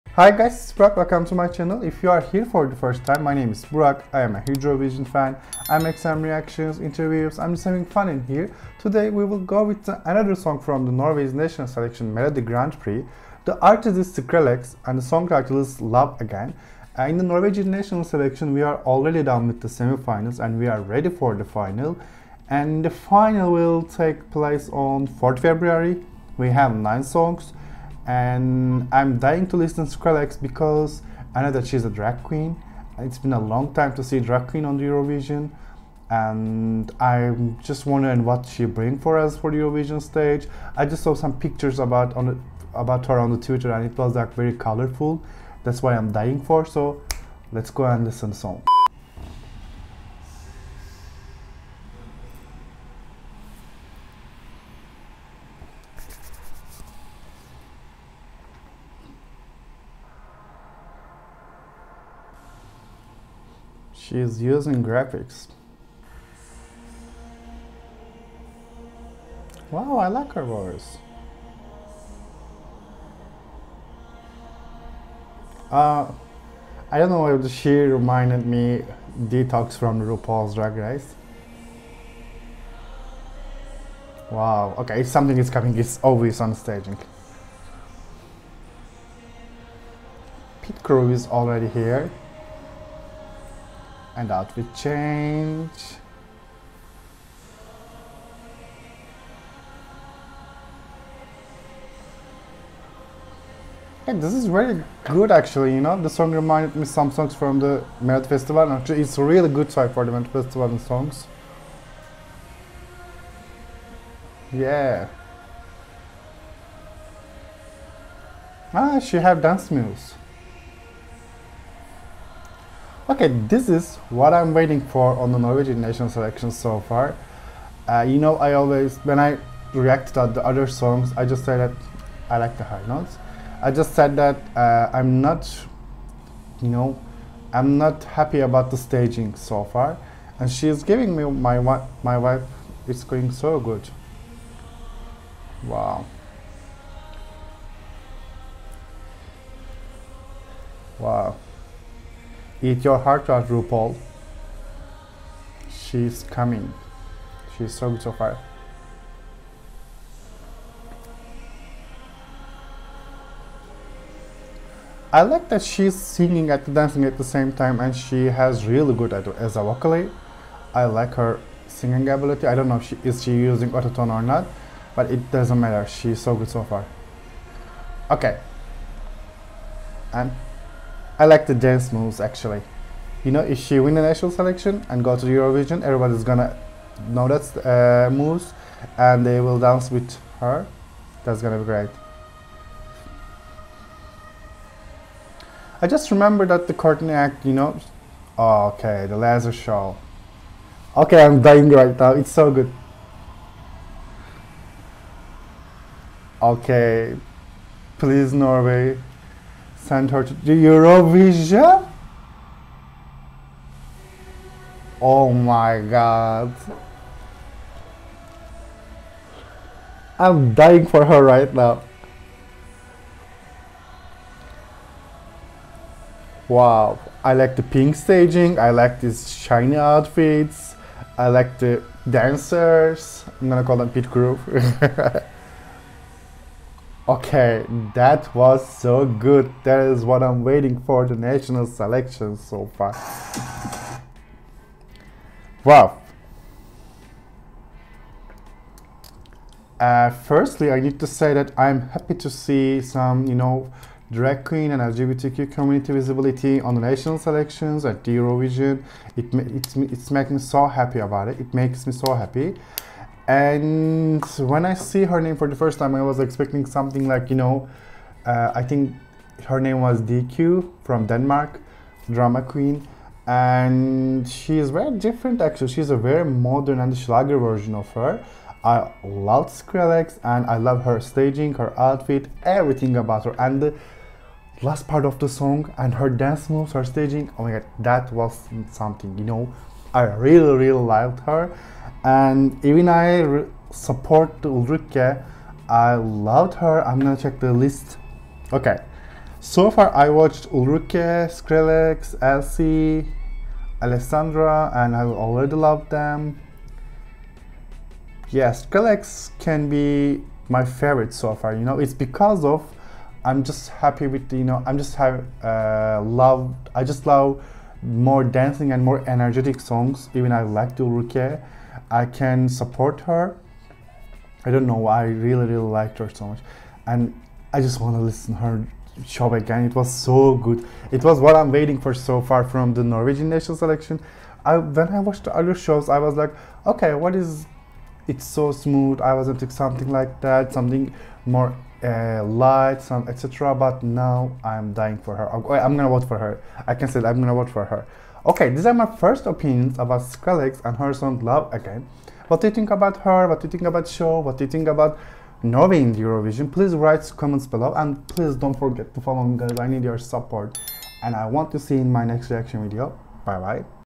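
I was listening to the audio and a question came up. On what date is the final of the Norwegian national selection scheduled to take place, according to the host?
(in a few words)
4 February.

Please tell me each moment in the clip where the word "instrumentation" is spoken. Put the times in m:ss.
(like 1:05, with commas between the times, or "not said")
not said.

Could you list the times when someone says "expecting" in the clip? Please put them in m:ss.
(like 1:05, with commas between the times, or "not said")
4:26, 5:39.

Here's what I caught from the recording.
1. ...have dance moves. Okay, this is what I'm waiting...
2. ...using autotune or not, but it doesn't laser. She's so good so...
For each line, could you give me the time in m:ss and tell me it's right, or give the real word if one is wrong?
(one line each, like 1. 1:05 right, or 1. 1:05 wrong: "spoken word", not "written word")
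1. 1:59 right
2. 2:53 wrong: "matter", not "laser".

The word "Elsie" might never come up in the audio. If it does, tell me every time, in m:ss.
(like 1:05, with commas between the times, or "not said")
5:02.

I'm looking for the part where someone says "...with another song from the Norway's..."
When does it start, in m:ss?
0:09.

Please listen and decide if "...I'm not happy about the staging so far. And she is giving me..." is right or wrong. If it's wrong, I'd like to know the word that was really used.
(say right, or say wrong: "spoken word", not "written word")
right.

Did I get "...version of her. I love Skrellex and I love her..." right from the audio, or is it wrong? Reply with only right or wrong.
right.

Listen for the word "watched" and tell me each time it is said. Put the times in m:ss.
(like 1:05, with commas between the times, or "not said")
5:00, 5:34.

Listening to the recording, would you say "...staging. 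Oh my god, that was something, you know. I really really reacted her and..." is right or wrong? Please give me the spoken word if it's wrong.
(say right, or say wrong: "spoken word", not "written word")
wrong: "liked", not "reacted".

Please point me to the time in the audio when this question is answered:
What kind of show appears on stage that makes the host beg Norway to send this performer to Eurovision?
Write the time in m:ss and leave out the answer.
3:19.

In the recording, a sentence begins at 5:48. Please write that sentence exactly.
Okay, these are my first opinions about Skrellex and her song Love Again.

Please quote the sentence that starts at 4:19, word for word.
It, it's, it's making me so happy about it.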